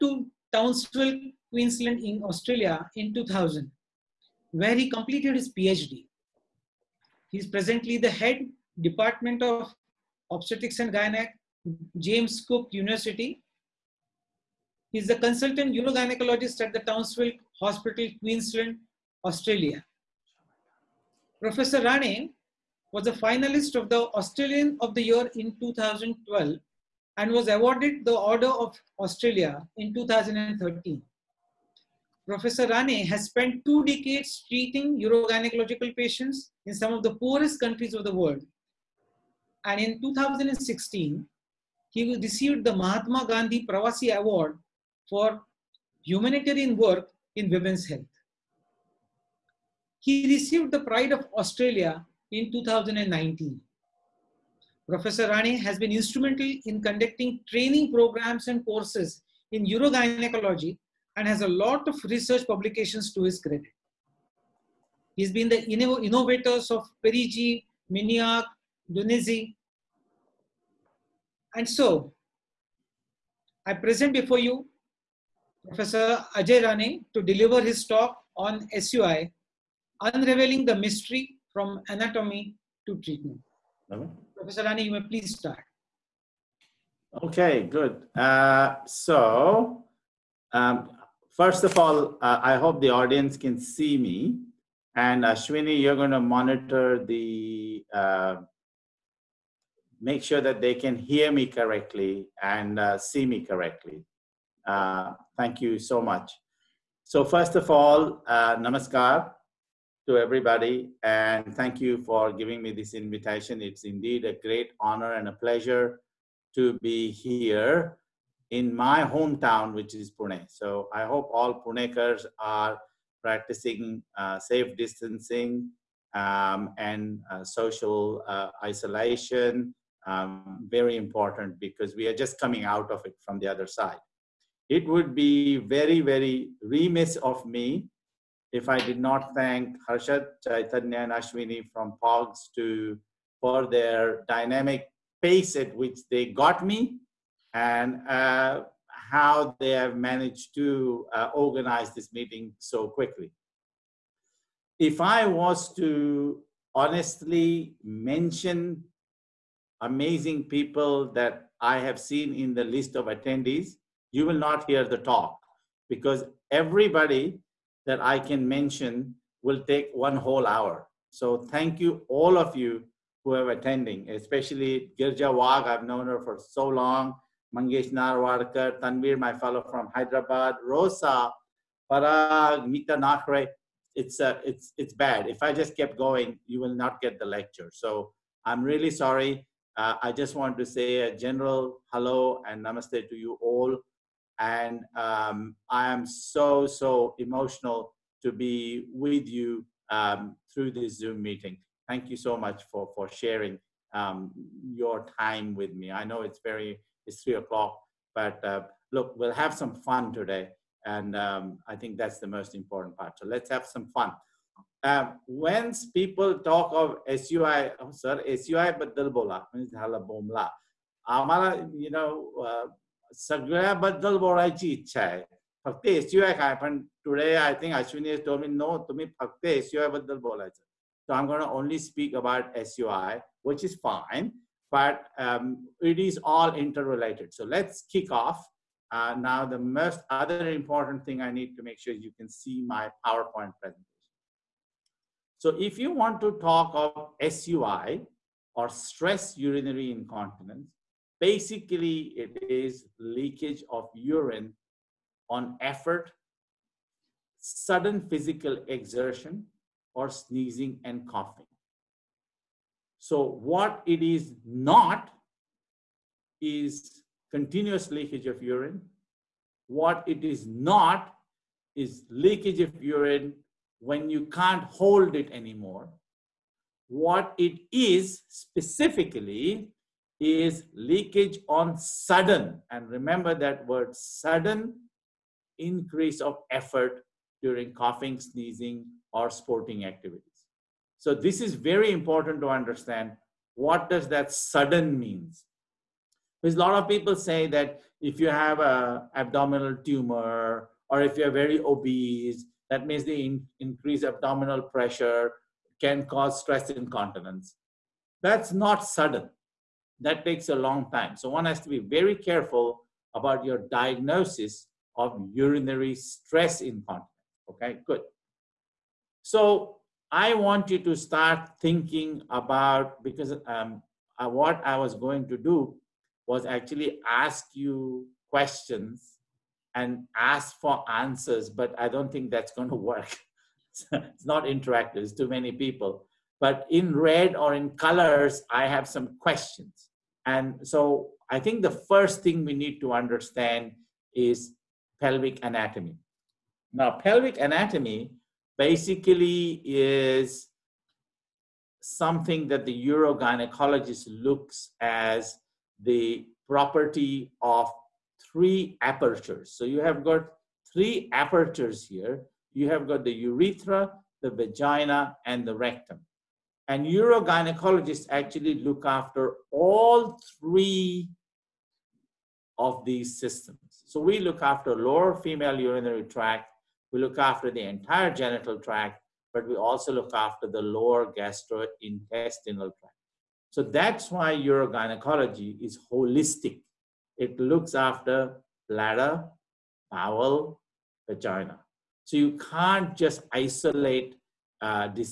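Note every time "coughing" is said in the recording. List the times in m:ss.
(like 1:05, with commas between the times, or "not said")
4:21, 4:47.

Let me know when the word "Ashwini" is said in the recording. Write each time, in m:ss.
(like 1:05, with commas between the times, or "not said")
1:35, 2:21.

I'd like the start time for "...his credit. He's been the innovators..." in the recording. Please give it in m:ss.
1:03.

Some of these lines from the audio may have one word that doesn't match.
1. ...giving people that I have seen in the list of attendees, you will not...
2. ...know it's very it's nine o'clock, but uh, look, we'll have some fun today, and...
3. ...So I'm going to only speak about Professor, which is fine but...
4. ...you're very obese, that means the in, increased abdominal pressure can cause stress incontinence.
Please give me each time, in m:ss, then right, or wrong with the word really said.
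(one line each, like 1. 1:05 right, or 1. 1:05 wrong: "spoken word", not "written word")
1. 2:39 wrong: "amazing", not "giving"
2. 3:26 wrong: "three", not "nine"
3. 3:51 wrong: "SUI", not "Professor"
4. 5:01 right.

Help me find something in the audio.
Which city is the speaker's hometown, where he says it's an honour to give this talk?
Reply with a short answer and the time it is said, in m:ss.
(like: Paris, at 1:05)
Pune, at 2:00.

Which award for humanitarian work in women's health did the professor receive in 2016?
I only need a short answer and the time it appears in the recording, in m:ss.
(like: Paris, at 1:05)
Mahatma Gandhi Pravasi Award, at 0:42.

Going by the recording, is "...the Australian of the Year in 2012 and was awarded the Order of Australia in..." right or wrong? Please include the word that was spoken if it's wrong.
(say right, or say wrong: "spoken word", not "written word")
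right.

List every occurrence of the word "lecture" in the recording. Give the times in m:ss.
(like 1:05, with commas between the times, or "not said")
3:07.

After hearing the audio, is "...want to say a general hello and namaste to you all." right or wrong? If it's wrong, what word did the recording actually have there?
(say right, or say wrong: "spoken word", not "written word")
right.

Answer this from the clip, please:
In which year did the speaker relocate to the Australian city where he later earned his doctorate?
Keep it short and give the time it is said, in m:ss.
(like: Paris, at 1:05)
2000, at 0:03.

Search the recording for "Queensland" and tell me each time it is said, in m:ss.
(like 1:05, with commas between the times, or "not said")
0:01, 0:18.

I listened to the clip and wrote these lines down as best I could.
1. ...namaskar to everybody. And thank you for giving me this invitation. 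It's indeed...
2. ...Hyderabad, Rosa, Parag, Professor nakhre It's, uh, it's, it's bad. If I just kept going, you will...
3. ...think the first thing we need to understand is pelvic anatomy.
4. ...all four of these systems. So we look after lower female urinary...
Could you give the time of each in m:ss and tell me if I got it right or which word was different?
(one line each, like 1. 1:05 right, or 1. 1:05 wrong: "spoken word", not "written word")
1. 1:48 right
2. 2:59 wrong: "Mita", not "Professor"
3. 5:41 right
4. 6:09 wrong: "three", not "four".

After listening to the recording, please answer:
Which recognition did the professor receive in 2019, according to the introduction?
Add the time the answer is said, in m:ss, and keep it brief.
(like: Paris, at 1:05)
Pride of Australia, at 0:50.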